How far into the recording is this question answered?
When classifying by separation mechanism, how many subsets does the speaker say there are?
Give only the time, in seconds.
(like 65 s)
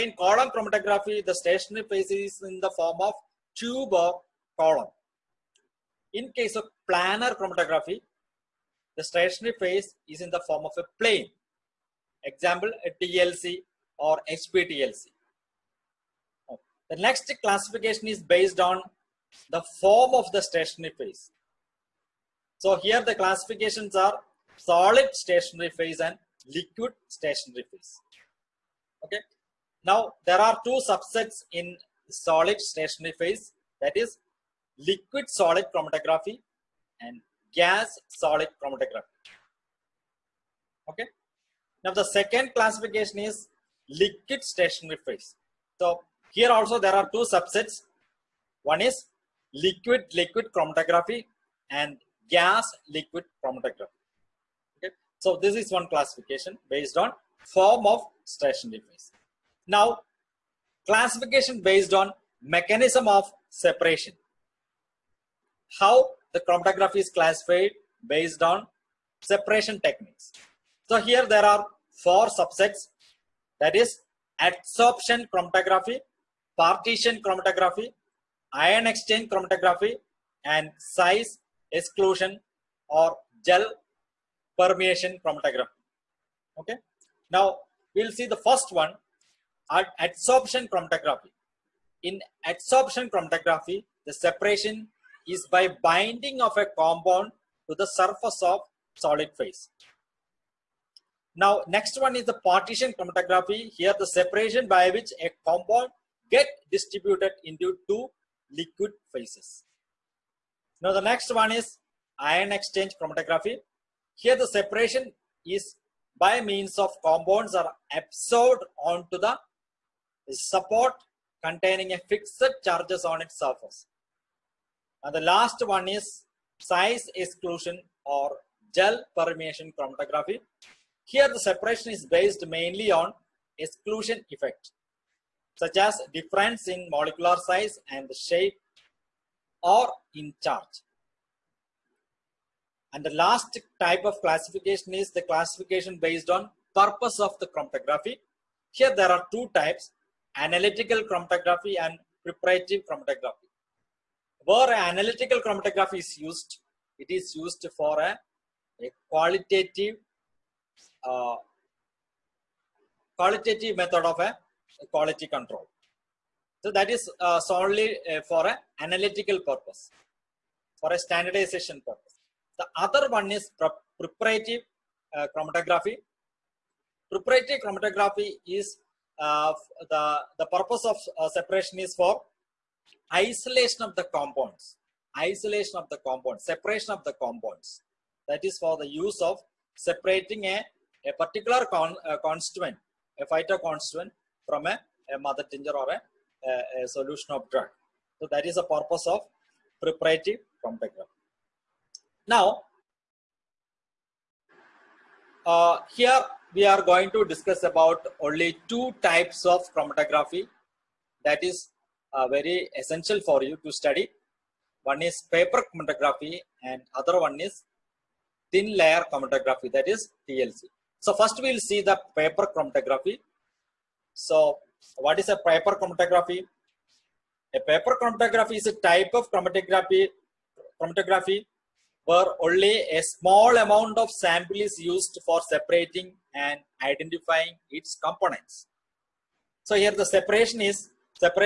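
72 s.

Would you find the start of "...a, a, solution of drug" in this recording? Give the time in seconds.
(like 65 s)
196 s.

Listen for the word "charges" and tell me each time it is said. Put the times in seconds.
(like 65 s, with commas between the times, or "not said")
122 s, 140 s.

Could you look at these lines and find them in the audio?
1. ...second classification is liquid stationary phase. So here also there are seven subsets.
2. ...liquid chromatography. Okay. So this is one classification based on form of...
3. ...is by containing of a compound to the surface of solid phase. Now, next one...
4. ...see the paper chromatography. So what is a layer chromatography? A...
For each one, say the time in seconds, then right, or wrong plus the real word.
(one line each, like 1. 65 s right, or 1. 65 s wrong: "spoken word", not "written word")
1. 42 s wrong: "two", not "seven"
2. 52 s right
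3. 95 s wrong: "binding", not "containing"
4. 221 s wrong: "paper", not "layer".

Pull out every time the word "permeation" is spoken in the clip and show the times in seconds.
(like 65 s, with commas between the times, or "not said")
84 s, 129 s.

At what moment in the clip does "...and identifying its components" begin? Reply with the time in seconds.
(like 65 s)
236 s.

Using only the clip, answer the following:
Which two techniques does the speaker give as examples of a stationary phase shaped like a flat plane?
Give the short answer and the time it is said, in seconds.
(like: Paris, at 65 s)
TLC or HPTLC, at 13 s.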